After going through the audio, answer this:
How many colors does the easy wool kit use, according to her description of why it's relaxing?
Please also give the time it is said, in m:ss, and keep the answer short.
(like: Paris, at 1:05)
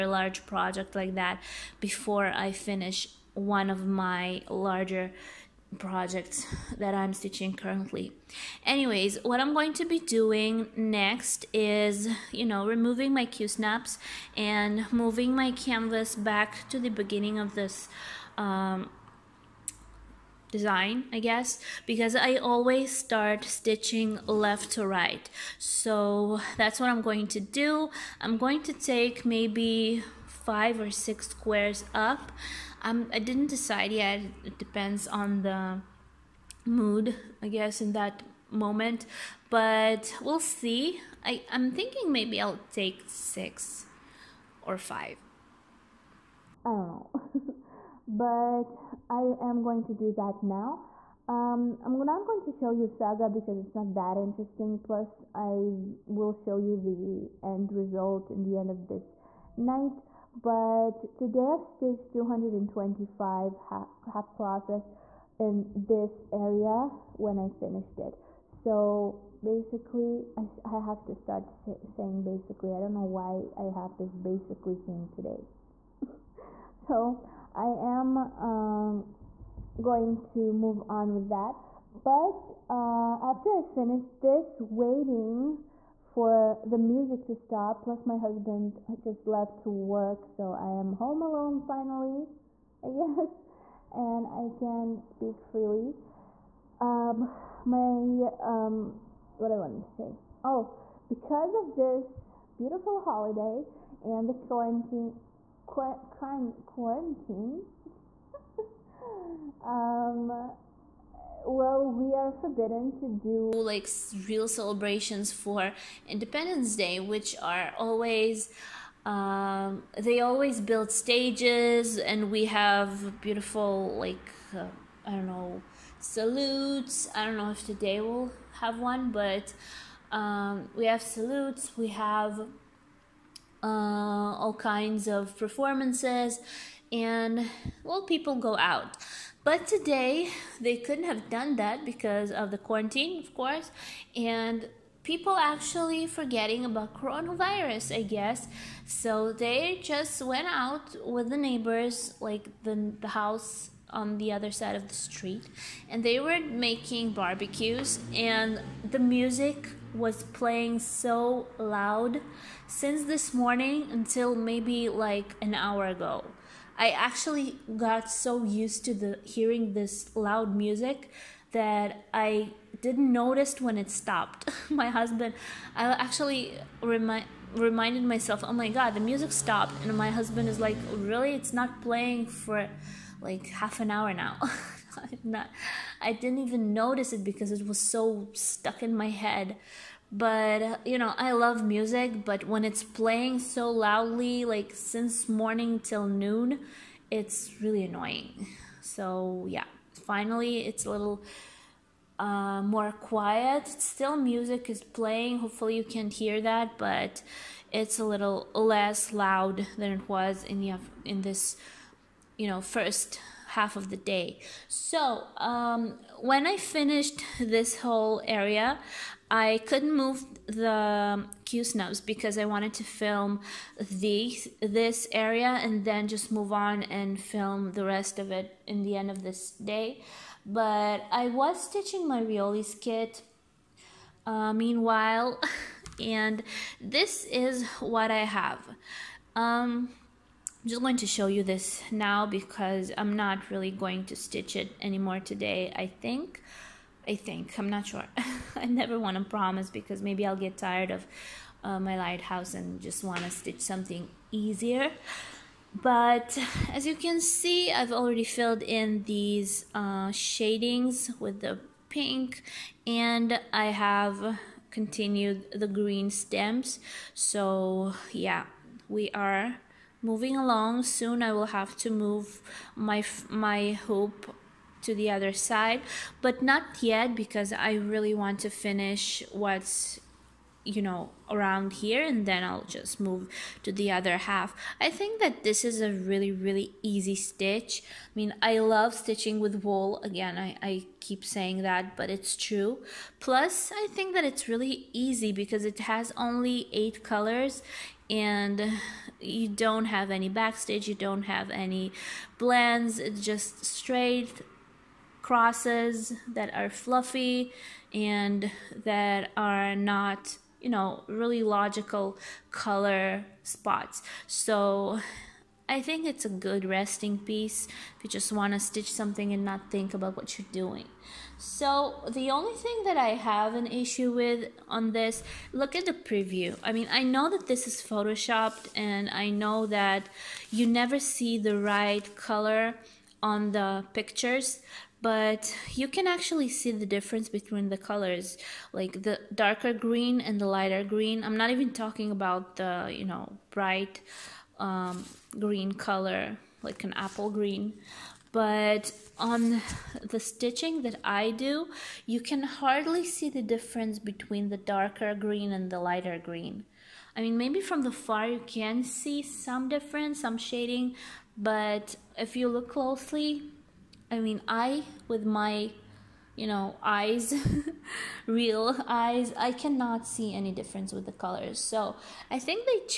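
8, at 4:56.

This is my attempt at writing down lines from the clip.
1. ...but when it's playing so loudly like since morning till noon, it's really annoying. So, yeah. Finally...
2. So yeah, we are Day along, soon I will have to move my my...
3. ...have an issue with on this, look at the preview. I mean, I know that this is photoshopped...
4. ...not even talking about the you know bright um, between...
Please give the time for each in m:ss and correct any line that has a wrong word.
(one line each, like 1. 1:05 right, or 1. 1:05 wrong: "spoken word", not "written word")
1. 3:12 right
2. 4:27 wrong: "Moving", not "Day"
3. 5:23 right
4. 5:41 wrong: "green", not "between".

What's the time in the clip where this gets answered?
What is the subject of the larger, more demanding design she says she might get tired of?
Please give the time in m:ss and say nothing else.
4:11.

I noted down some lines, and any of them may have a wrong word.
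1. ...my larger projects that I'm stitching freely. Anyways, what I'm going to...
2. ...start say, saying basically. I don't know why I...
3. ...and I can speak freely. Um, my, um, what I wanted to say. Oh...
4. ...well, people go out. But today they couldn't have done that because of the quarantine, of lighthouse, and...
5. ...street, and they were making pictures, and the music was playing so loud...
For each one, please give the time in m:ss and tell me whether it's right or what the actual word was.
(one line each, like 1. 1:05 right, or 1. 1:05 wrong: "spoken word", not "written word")
1. 0:03 wrong: "currently", not "freely"
2. 1:11 right
3. 1:33 right
4. 2:17 wrong: "course", not "lighthouse"
5. 2:34 wrong: "barbecues", not "pictures".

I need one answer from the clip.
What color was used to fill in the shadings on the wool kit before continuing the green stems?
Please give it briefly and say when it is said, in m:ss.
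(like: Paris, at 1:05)
pink, at 4:21.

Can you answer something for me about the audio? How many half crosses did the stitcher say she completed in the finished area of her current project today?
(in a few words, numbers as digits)
225.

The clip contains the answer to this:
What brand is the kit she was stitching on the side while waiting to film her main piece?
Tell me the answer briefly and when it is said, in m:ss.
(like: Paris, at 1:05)
Riolis, at 3:52.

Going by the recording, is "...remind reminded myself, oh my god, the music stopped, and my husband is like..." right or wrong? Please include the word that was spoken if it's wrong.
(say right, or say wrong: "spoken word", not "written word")
right.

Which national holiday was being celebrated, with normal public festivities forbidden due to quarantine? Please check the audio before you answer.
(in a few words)
Independence Day.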